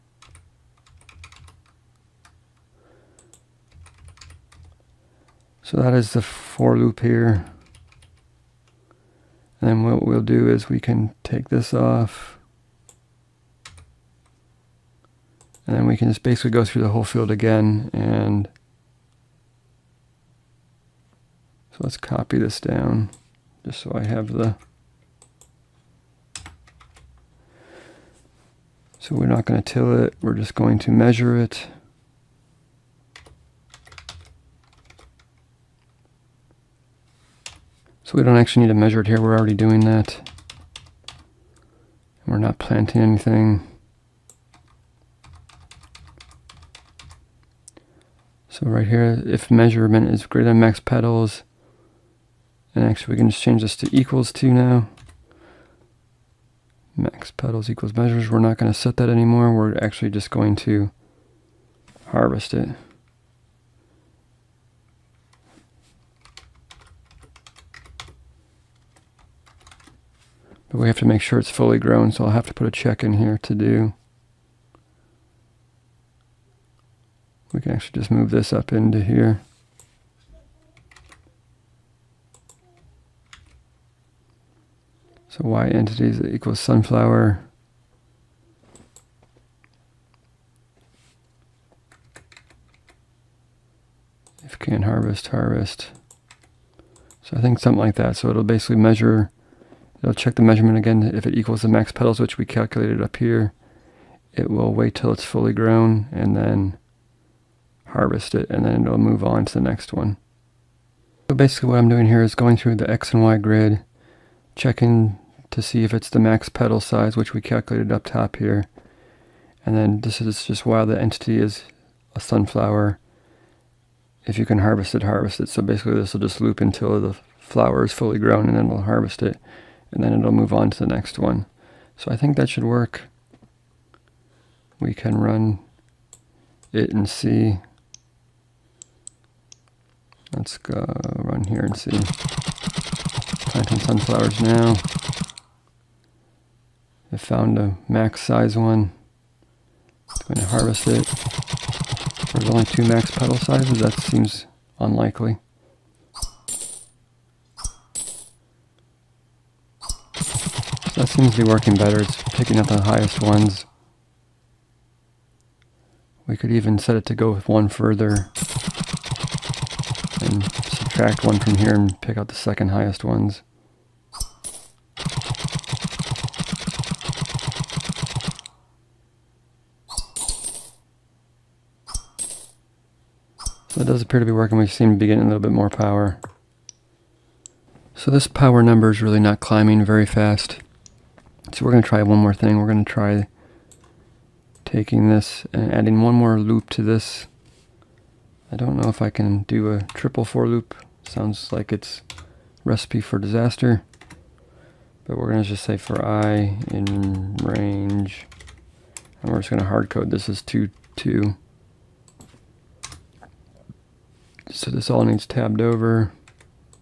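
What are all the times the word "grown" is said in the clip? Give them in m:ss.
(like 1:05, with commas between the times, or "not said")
1:11, 1:45, 2:08.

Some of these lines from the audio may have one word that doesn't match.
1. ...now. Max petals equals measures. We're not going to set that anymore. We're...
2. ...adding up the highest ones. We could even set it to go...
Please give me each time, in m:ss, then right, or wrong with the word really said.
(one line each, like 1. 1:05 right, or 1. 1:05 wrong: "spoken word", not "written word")
1. 0:54 right
2. 2:42 wrong: "picking", not "adding".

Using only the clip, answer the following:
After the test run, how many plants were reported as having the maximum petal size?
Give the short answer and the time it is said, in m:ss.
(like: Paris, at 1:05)
2, at 2:32.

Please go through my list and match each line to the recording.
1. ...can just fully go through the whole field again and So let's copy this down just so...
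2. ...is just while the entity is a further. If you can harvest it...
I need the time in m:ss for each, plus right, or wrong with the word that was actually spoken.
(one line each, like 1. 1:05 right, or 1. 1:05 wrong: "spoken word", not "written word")
1. 0:15 wrong: "basically", not "fully"
2. 2:00 wrong: "sunflower", not "further".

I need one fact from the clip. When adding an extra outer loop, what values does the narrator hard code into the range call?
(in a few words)
2, 2.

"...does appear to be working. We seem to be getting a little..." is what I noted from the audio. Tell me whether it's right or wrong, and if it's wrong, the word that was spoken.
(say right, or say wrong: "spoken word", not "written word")
right.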